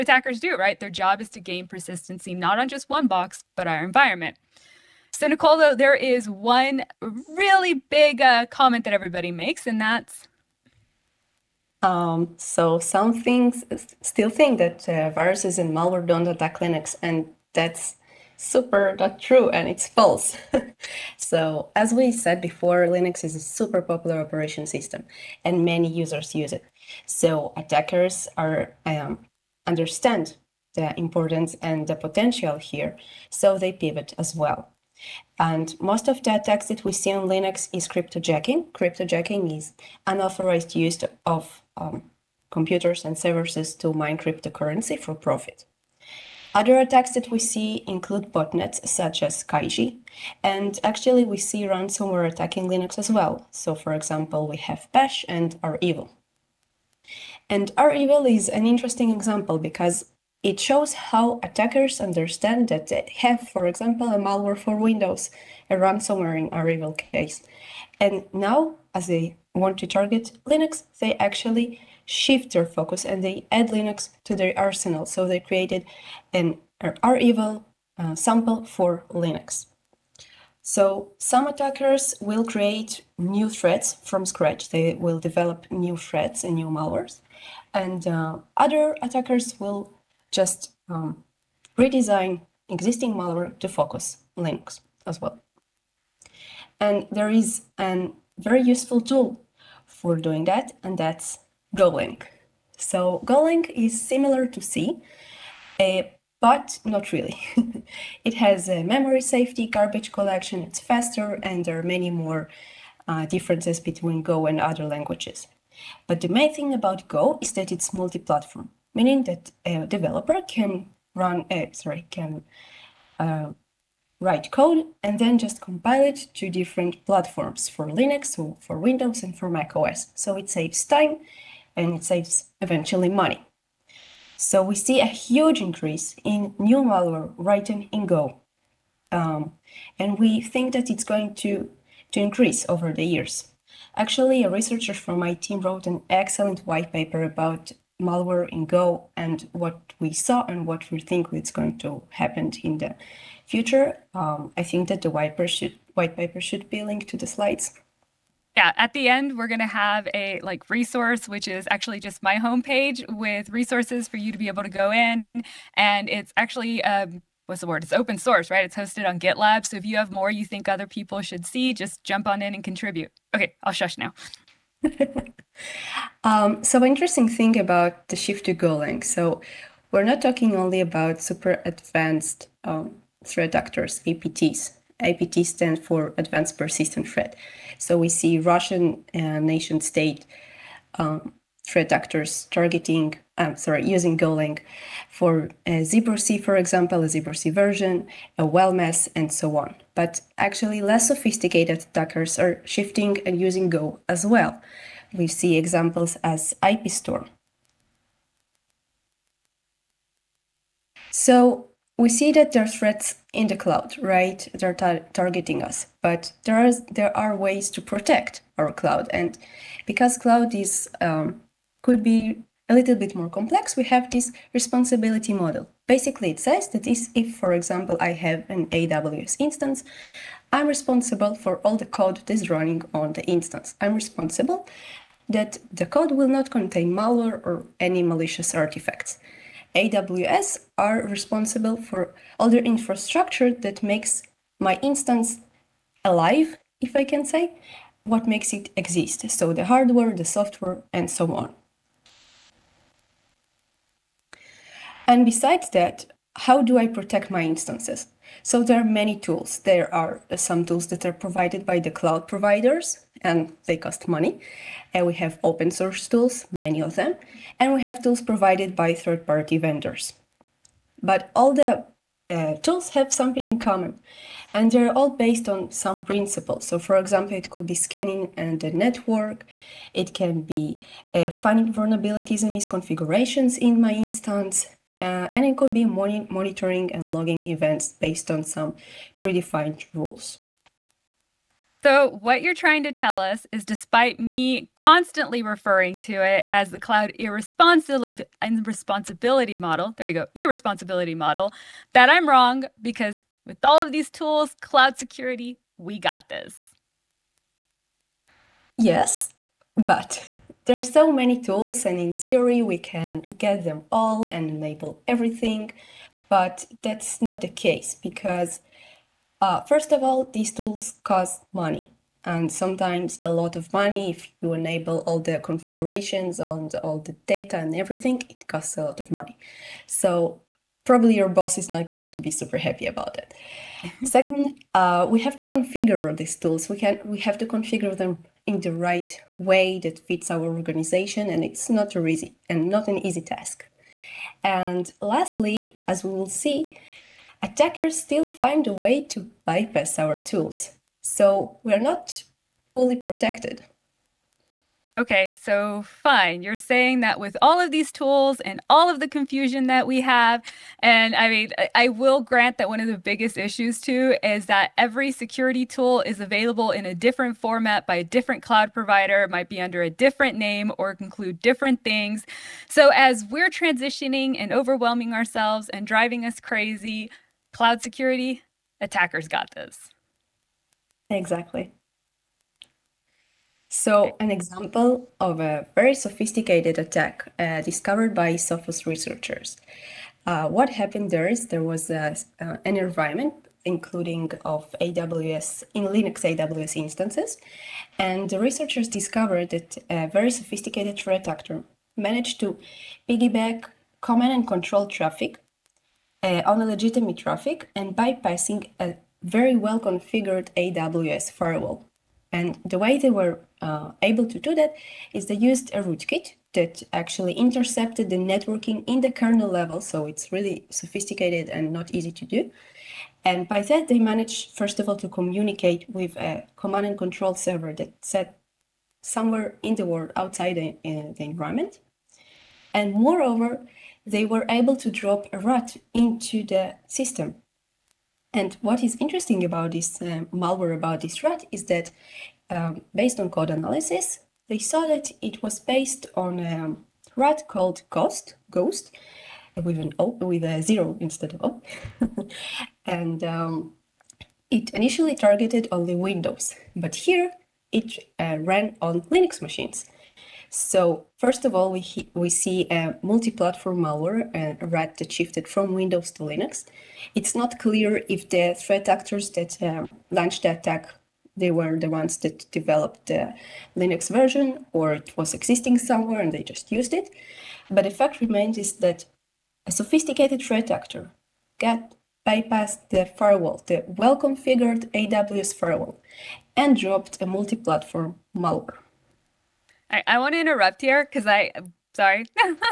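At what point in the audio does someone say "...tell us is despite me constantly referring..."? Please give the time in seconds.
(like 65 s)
292 s.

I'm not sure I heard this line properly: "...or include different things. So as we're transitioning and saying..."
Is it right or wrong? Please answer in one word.
wrong.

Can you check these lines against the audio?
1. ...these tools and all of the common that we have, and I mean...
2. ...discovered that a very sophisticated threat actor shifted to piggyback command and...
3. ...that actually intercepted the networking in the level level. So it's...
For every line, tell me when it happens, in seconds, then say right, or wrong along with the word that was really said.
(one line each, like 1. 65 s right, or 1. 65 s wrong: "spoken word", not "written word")
1. 357 s wrong: "confusion", not "common"
2. 398 s wrong: "managed", not "shifted"
3. 416 s wrong: "kernel", not "level".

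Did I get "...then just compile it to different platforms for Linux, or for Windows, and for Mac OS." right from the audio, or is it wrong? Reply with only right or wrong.
right.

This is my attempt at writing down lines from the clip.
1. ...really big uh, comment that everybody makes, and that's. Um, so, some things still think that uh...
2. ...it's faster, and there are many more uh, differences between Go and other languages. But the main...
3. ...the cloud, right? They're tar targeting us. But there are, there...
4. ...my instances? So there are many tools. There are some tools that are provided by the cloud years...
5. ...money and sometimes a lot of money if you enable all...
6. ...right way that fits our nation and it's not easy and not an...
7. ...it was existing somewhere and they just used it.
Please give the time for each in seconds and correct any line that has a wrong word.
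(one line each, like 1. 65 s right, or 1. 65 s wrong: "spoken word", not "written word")
1. 7 s right
2. 110 s right
3. 213 s right
4. 257 s wrong: "providers", not "years"
5. 321 s right
6. 338 s wrong: "organization", not "nation"
7. 474 s right.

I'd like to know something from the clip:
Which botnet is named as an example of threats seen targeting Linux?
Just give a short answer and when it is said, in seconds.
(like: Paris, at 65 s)
Kaiji, at 49 s.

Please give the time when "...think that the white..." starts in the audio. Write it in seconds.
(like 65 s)
154 s.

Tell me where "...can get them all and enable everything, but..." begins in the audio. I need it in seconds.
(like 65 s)
312 s.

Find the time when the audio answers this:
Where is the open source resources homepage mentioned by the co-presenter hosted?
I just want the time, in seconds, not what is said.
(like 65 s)
169 s.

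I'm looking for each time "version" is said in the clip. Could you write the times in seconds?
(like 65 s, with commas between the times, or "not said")
197 s, 474 s.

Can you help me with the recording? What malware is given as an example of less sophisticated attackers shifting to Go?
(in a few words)
IPStorm.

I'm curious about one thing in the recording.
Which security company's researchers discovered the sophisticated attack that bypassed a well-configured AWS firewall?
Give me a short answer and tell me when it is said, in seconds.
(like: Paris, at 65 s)
Sophos, at 388 s.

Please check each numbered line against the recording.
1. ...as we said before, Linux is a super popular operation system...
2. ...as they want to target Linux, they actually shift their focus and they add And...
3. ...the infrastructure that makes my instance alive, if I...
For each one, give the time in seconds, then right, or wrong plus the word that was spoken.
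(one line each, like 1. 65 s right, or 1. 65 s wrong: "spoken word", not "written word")
1. 21 s right
2. 68 s wrong: "Linux", not "And"
3. 242 s right.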